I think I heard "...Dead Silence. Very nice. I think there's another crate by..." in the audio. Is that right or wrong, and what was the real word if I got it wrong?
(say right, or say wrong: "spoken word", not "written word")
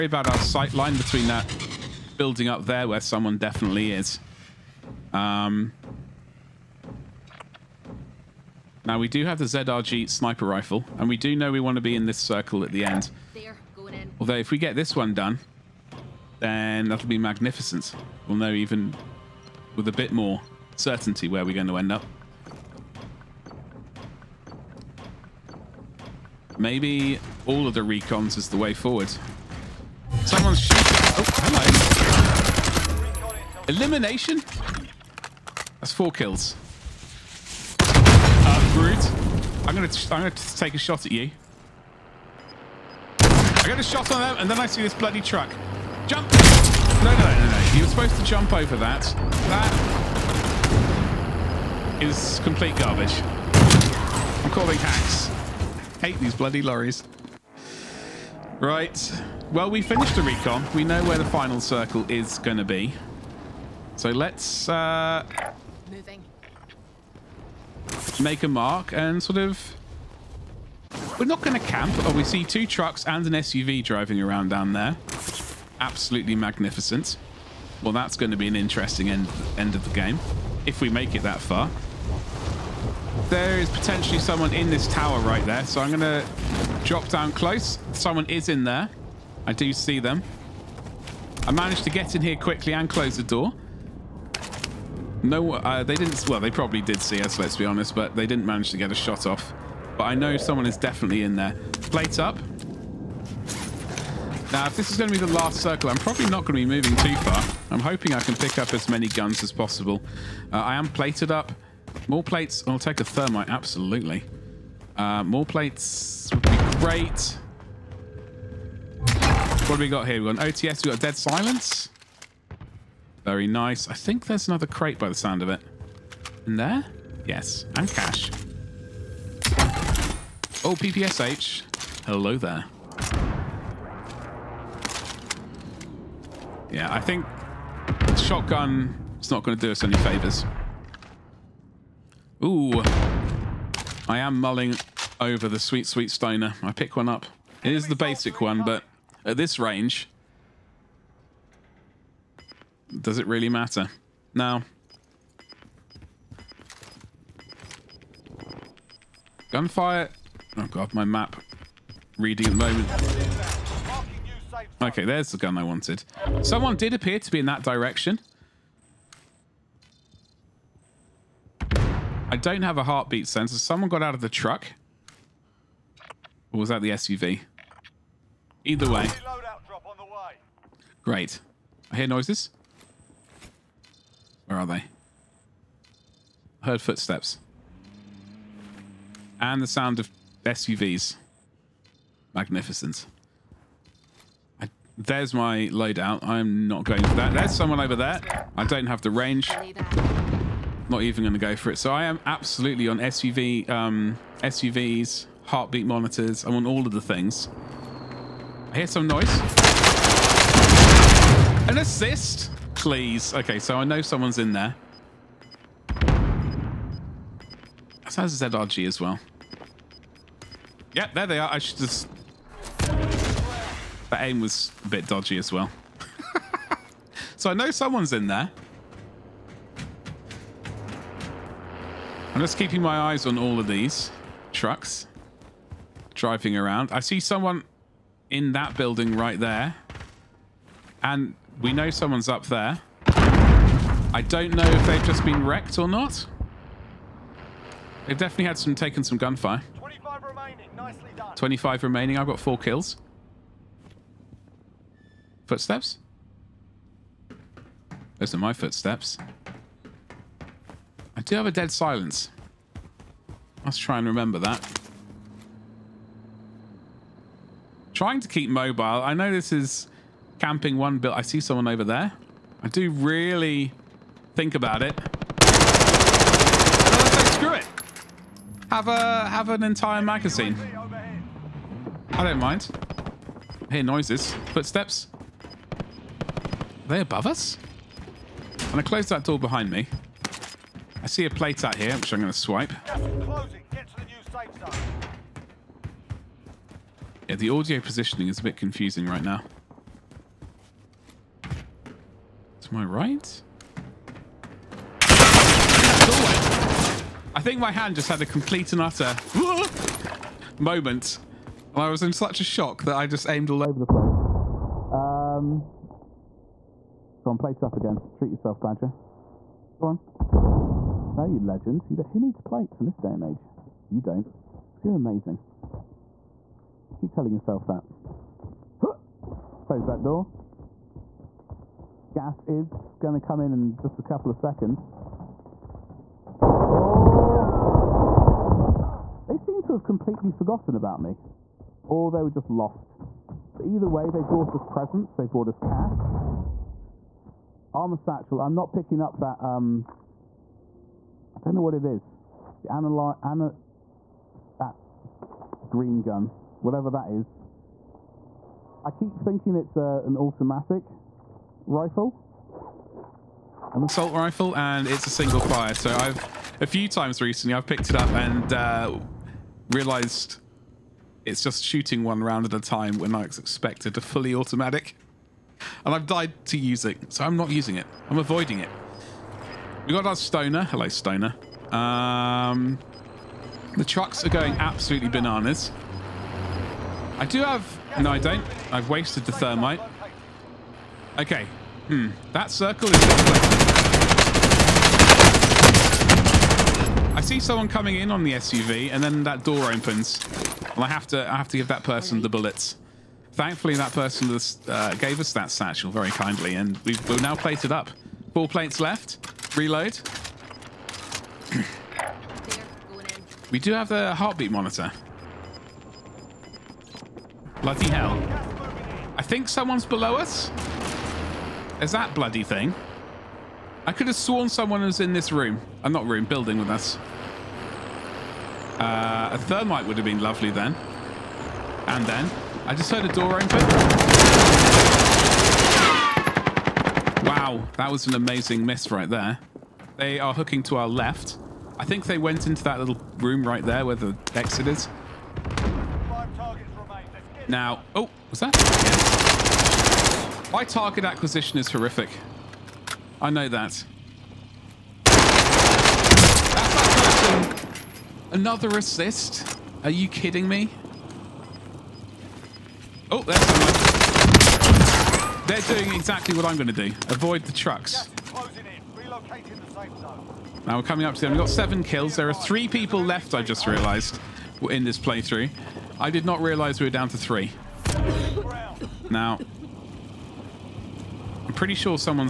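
right.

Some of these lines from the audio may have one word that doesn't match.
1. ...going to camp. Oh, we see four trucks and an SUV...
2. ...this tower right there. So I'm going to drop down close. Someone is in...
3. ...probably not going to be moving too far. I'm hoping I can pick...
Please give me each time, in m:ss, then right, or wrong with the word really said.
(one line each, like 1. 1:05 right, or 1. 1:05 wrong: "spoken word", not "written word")
1. 1:11 wrong: "two", not "four"
2. 1:24 right
3. 1:45 right.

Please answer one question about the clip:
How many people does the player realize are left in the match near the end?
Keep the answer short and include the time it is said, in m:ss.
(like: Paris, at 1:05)
3, at 7:52.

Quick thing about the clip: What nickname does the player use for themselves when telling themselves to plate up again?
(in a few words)
Badger.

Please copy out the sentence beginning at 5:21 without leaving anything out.
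You who needs plates in this day and age?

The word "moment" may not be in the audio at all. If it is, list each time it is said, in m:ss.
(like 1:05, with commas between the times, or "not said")
2:42, 5:10.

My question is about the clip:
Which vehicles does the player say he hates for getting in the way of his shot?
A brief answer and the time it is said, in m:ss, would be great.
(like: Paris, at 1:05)
Lorries, at 0:56.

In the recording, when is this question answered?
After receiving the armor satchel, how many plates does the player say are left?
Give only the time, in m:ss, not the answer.
6:48.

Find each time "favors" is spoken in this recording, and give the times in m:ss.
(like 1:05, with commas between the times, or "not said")
2:19.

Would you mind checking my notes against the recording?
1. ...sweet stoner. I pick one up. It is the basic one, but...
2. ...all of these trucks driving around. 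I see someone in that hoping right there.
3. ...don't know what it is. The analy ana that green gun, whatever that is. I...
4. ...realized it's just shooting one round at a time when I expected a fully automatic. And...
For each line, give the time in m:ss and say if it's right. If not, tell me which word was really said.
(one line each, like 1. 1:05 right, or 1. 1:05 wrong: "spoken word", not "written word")
1. 2:25 right
2. 3:53 wrong: "building", not "hoping"
3. 5:51 right
4. 6:09 right.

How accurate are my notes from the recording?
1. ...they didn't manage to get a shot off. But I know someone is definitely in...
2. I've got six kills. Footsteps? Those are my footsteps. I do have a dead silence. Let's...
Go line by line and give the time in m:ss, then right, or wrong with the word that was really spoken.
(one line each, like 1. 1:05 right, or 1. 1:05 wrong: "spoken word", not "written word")
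1. 1:38 right
2. 4:12 wrong: "four", not "six".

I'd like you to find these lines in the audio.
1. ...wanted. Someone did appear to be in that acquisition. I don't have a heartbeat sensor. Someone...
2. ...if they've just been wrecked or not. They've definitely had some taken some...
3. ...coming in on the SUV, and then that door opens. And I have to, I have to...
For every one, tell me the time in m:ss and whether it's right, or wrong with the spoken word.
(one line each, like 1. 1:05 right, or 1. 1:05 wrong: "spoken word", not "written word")
1. 2:45 wrong: "direction", not "acquisition"
2. 4:04 right
3. 6:37 right.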